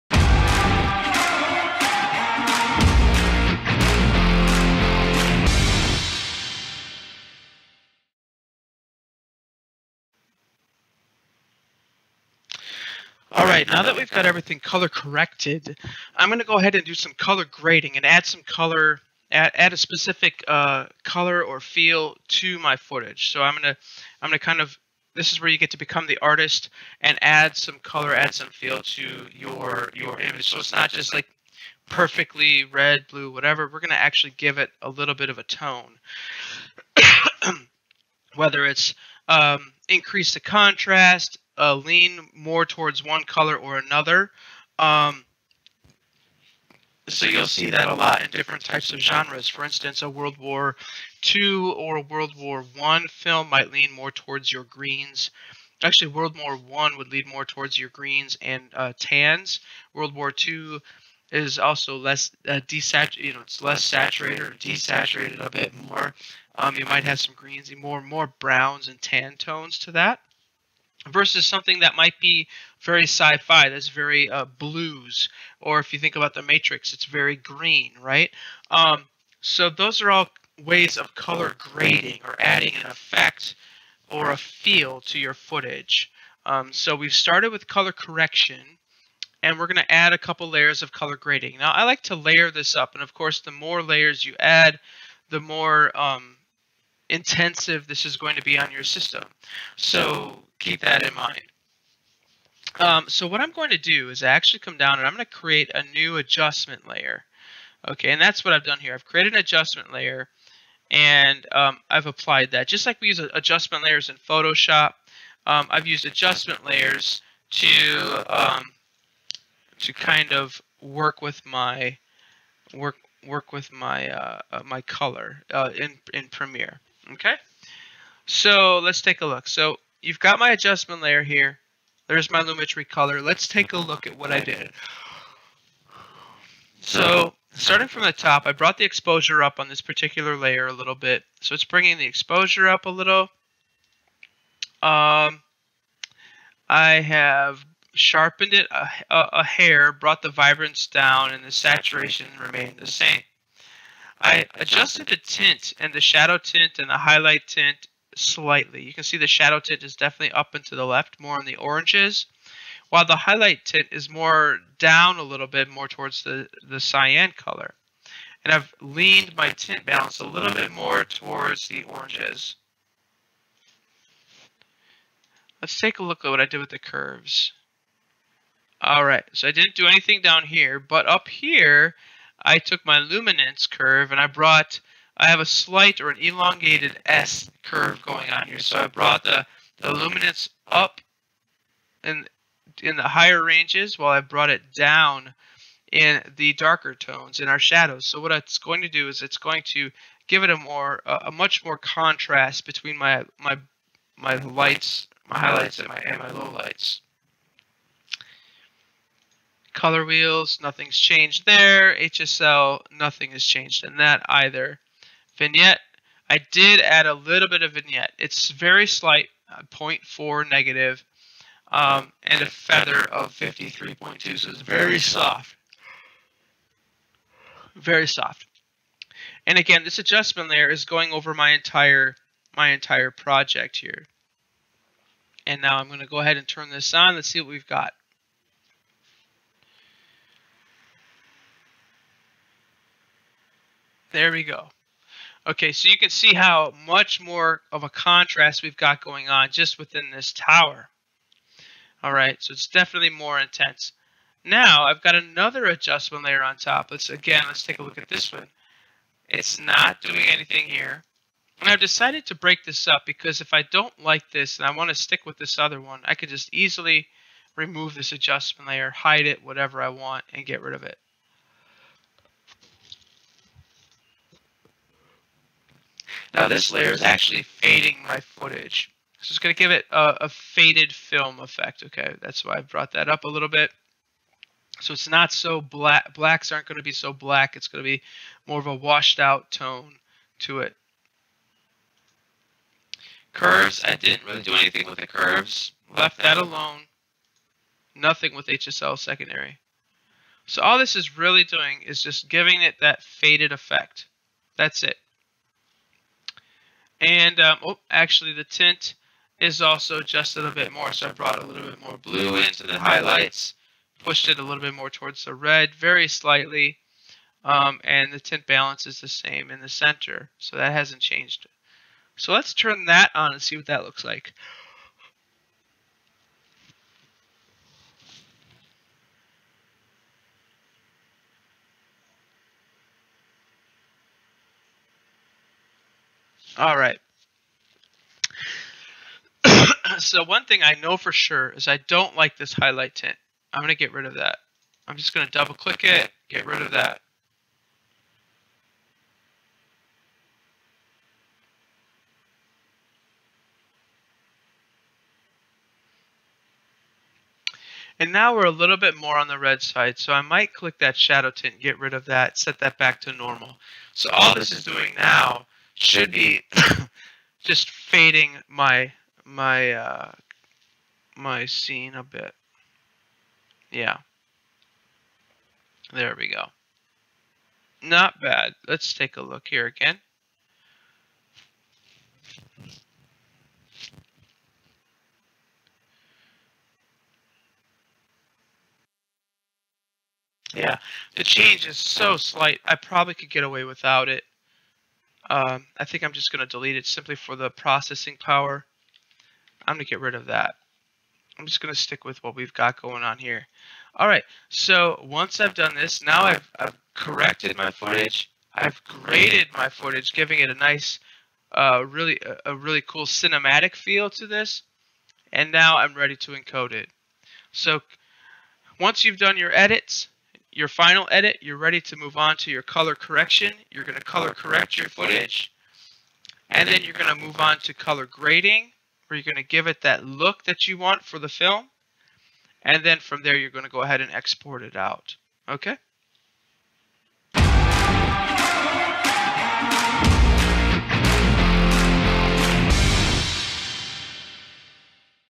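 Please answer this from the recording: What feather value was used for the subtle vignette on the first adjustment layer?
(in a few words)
53.2.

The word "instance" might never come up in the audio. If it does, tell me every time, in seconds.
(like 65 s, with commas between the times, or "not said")
49 s.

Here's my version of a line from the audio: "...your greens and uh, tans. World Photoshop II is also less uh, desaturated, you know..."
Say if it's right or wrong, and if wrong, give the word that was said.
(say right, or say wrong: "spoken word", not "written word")
wrong: "War", not "Photoshop".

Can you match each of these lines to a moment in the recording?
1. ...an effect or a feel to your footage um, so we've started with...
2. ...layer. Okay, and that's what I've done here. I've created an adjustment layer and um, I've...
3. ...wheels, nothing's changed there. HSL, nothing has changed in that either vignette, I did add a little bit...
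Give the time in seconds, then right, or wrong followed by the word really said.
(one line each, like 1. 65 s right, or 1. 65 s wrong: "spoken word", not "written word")
1. 82 s right
2. 106 s right
3. 210 s right.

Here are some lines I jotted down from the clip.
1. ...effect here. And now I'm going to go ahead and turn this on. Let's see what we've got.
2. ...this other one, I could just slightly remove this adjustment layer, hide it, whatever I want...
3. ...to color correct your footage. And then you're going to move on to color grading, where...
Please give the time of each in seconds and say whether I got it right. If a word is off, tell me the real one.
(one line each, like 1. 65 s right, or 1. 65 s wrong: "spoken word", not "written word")
1. 233 s wrong: "project", not "effect"
2. 265 s wrong: "easily", not "slightly"
3. 423 s right.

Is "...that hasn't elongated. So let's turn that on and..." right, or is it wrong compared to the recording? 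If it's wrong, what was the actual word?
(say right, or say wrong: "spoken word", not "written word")
wrong: "changed", not "elongated".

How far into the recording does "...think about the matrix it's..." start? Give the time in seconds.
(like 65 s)
75 s.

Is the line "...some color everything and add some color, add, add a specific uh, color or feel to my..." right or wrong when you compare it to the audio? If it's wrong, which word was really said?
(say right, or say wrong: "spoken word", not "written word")
wrong: "grading", not "everything".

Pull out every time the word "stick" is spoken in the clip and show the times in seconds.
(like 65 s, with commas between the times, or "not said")
264 s, 401 s.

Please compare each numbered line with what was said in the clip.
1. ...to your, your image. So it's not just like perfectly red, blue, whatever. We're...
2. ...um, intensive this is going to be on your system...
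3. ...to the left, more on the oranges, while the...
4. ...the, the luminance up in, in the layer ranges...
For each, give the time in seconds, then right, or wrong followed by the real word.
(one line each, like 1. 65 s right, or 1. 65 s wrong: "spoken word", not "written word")
1. 28 s right
2. 95 s right
3. 160 s right
4. 189 s wrong: "higher", not "layer".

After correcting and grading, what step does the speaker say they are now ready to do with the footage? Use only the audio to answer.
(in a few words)
Encode it.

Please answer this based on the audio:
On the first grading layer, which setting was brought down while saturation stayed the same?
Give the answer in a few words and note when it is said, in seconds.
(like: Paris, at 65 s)
Vibrance, at 150 s.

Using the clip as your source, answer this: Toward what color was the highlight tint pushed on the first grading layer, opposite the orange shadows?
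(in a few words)
Cyan.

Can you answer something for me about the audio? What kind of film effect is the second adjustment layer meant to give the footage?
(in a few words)
Faded film effect.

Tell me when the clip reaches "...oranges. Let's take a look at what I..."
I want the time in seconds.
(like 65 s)
171 s.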